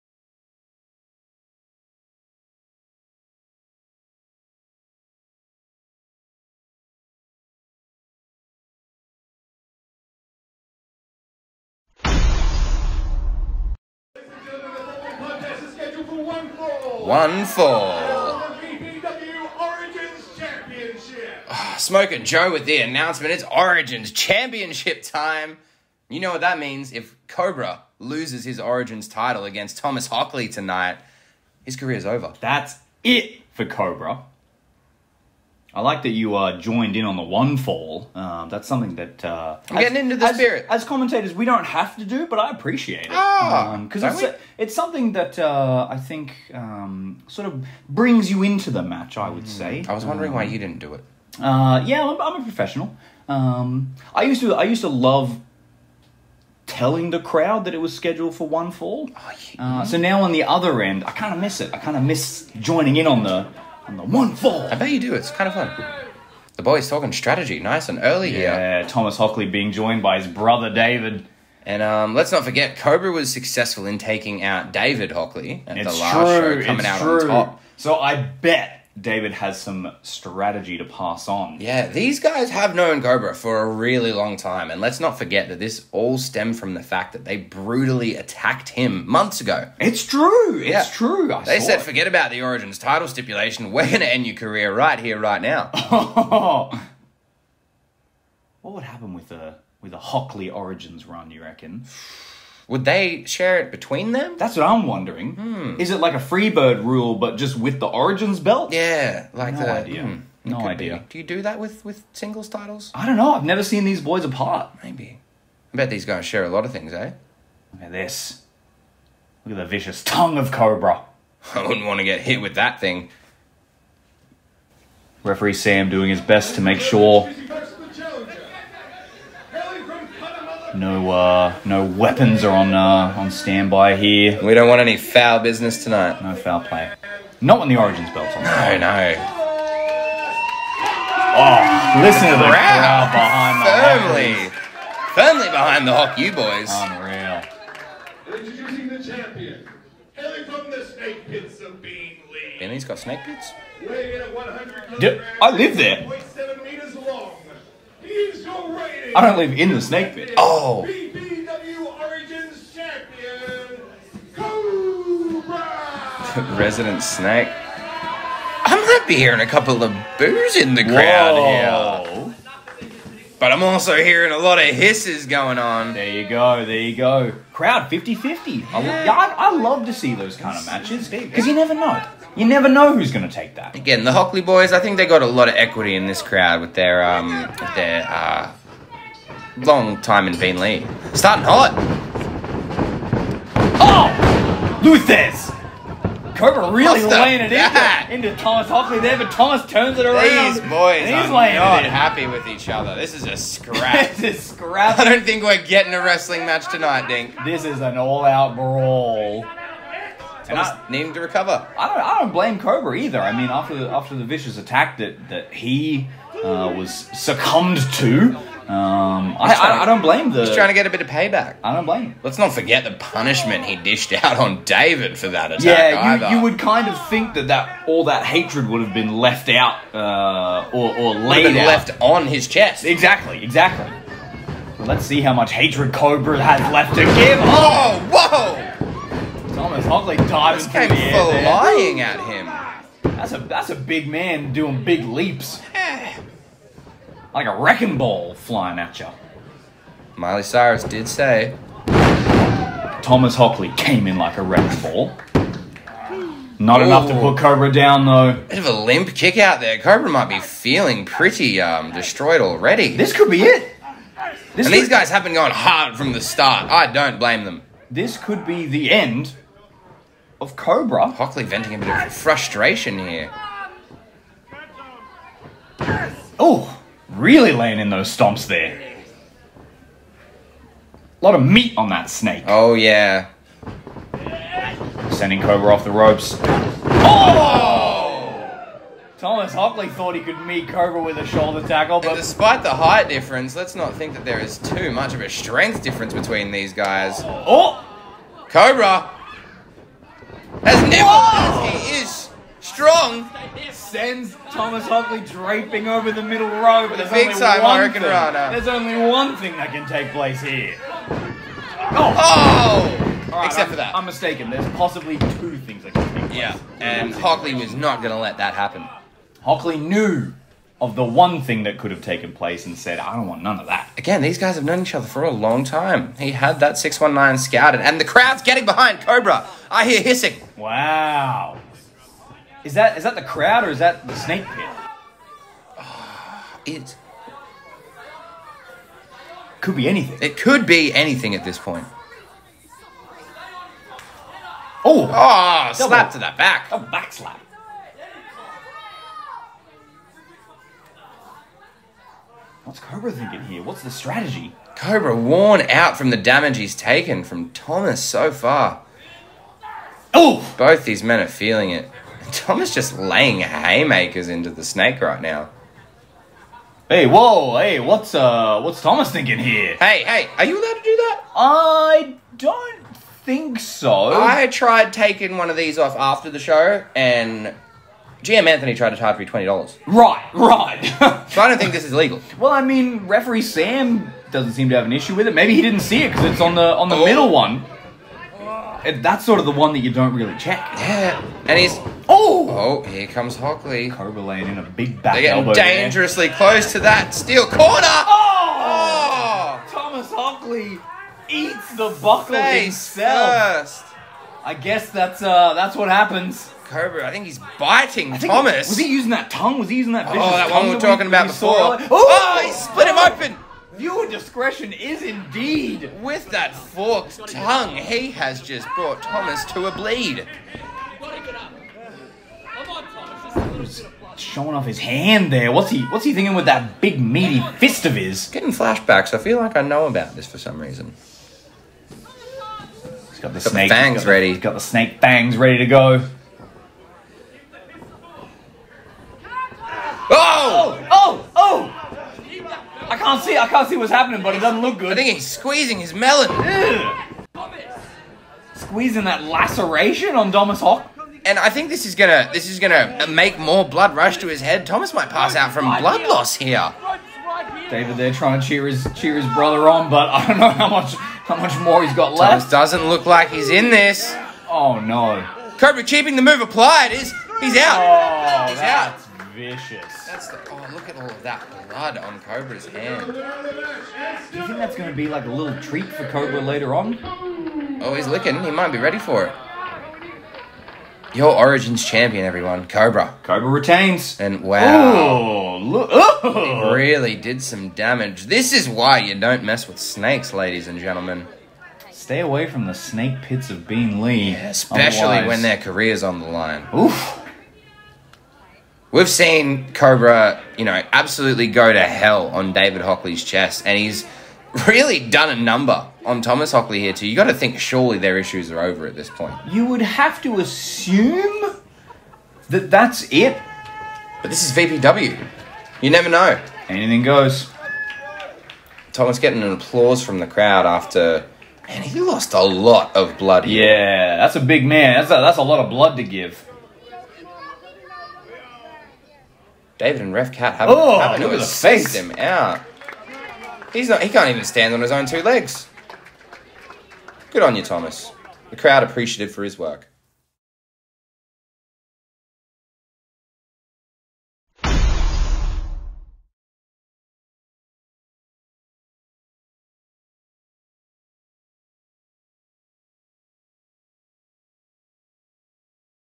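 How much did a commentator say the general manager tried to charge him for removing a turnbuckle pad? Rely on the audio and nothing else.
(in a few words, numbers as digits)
$20.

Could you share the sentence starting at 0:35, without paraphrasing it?
I like that you uh, joined in on the one fall.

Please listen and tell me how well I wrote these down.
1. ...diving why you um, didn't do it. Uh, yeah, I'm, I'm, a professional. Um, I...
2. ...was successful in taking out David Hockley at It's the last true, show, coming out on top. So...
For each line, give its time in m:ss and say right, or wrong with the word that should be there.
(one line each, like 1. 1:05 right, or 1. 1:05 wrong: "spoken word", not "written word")
1. 0:50 wrong: "wondering", not "diving"
2. 1:13 right.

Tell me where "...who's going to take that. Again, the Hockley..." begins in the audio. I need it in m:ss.
3:02.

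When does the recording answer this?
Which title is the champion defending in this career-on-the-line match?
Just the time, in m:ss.
0:23.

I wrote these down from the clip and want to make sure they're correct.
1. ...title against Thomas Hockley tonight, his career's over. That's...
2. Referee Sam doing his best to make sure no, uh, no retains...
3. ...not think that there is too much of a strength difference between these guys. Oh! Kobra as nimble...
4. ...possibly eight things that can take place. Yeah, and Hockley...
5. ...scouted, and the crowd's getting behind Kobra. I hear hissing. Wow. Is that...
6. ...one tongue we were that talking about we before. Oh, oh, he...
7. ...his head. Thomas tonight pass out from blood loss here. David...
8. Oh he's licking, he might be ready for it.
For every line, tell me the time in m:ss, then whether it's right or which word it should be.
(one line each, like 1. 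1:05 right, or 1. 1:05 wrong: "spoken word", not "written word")
1. 0:29 right
2. 2:05 wrong: "weapons", not "retains"
3. 4:53 right
4. 5:14 wrong: "two", not "eight"
5. 5:27 right
6. 6:50 right
7. 7:34 wrong: "might", not "tonight"
8. 7:57 right.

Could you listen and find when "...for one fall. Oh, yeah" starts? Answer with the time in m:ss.
0:58.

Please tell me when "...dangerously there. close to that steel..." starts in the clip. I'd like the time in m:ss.
6:35.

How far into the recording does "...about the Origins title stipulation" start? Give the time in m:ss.
1:32.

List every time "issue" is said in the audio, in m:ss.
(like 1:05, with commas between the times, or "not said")
6:24, 8:28.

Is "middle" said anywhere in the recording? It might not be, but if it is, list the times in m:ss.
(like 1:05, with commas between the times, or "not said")
5:06, 6:27.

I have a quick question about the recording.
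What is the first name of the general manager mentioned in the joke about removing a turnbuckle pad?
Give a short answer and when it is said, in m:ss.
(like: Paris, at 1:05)
Anthony, at 6:18.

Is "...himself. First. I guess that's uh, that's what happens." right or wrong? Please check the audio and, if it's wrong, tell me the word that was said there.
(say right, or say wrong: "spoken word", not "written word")
right.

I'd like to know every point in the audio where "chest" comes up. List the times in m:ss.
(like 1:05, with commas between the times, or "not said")
3:52, 8:23.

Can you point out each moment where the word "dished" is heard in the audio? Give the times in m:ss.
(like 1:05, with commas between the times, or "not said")
3:43.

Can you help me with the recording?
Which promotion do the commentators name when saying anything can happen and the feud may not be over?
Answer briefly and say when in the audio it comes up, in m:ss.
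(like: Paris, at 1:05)
VPW, at 8:34.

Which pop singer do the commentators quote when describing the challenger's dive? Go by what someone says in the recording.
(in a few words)
Miley Cyrus.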